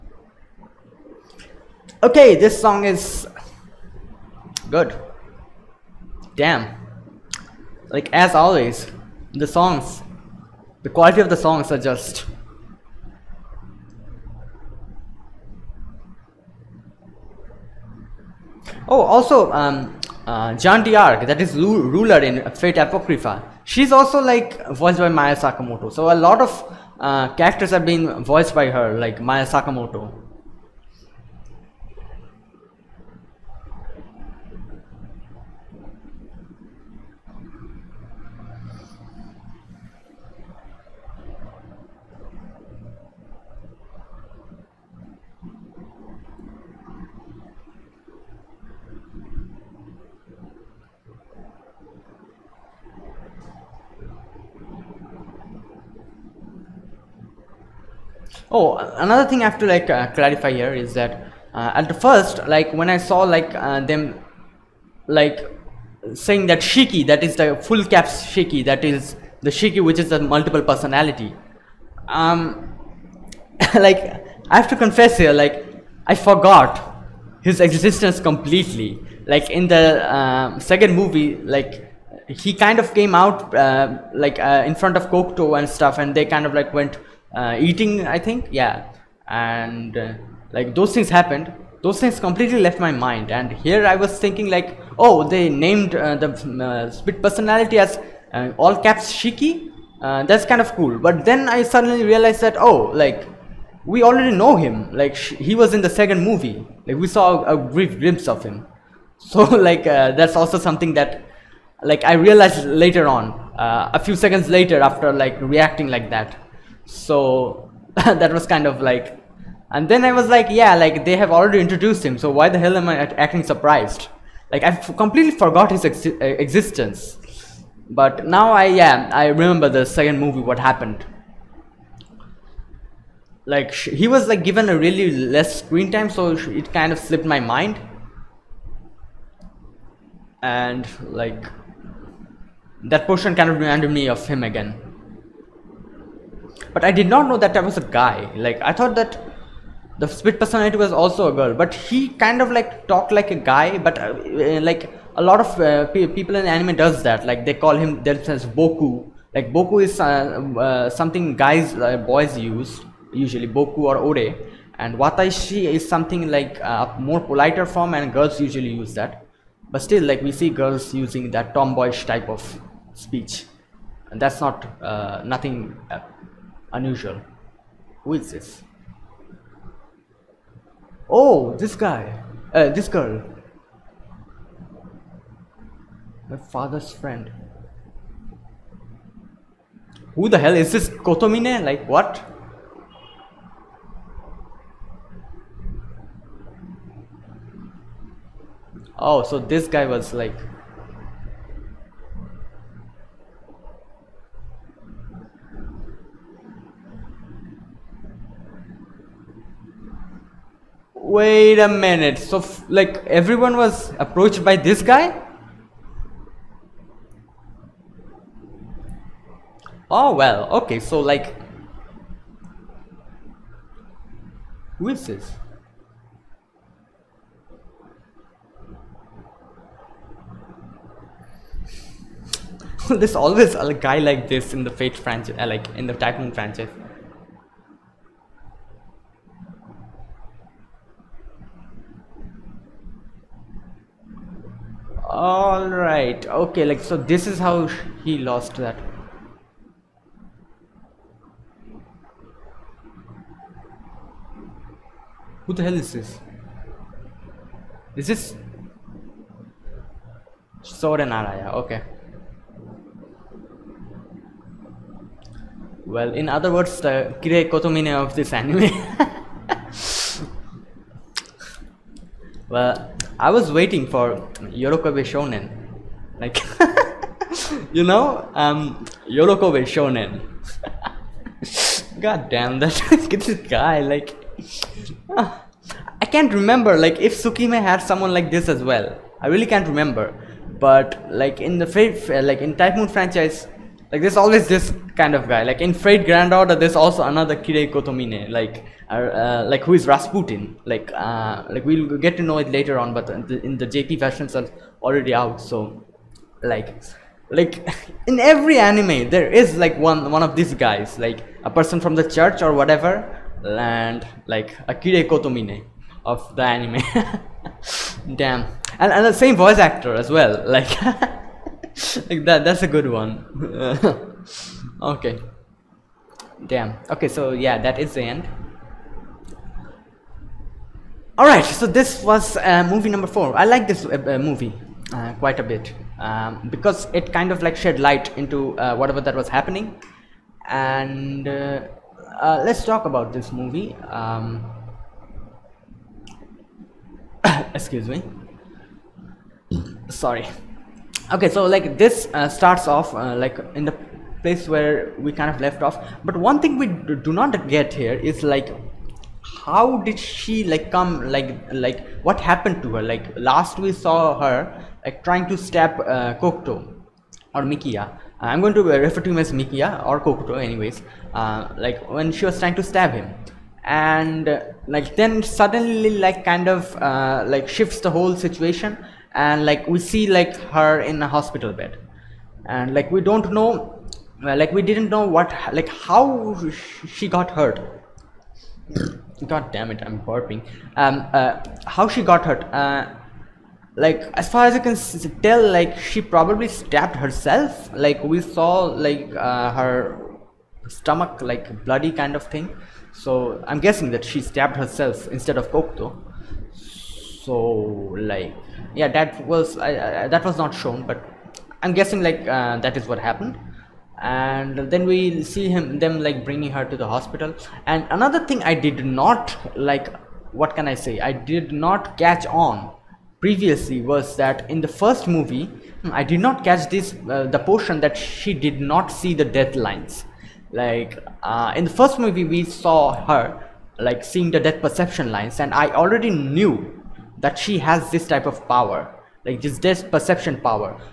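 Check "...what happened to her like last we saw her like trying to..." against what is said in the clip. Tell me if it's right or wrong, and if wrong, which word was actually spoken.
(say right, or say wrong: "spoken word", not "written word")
right.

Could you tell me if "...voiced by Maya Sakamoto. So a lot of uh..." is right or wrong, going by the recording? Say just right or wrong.
right.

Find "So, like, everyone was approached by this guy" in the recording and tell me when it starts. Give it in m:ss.
3:32.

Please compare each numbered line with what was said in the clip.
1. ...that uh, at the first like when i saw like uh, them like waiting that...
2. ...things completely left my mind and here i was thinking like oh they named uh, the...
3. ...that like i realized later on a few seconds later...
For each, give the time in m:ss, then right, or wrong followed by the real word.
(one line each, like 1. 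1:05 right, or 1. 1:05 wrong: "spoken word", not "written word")
1. 1:00 wrong: "saying", not "waiting"
2. 1:31 right
3. 1:50 right.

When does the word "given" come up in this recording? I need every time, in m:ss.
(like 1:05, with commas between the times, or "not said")
2:14.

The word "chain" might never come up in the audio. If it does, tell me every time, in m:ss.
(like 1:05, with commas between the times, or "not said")
not said.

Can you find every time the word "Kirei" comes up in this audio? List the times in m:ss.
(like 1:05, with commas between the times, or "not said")
4:27, 4:57, 5:14.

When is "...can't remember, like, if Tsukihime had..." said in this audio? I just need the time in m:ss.
4:46.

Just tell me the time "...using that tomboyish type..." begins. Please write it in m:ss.
2:50.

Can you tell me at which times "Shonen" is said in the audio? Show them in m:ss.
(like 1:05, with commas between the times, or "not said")
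4:35, 4:39.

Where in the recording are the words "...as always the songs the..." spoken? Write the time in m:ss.
0:08.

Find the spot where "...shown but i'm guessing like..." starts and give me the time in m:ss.
6:50.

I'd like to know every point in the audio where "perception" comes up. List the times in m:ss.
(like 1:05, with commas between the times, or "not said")
7:14, 7:19.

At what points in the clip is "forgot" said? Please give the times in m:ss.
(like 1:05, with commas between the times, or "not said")
1:16, 2:05.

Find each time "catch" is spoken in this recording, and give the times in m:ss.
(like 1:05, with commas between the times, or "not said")
7:02, 7:06.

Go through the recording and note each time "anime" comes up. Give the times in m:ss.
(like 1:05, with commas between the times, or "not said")
2:36, 4:28, 5:08, 5:16.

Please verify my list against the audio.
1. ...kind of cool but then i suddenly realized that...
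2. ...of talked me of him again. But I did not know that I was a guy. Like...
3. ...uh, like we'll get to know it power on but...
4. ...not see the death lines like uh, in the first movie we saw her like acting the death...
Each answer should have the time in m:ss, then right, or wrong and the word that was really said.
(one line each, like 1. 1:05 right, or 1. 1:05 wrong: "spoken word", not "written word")
1. 1:40 right
2. 2:23 wrong: "reminded", not "talked"
3. 5:00 wrong: "later", not "power"
4. 7:08 wrong: "seeing", not "acting".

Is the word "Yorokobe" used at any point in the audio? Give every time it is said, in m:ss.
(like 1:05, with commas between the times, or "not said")
4:34, 4:39.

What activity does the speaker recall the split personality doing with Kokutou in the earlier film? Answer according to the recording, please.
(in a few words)
eating.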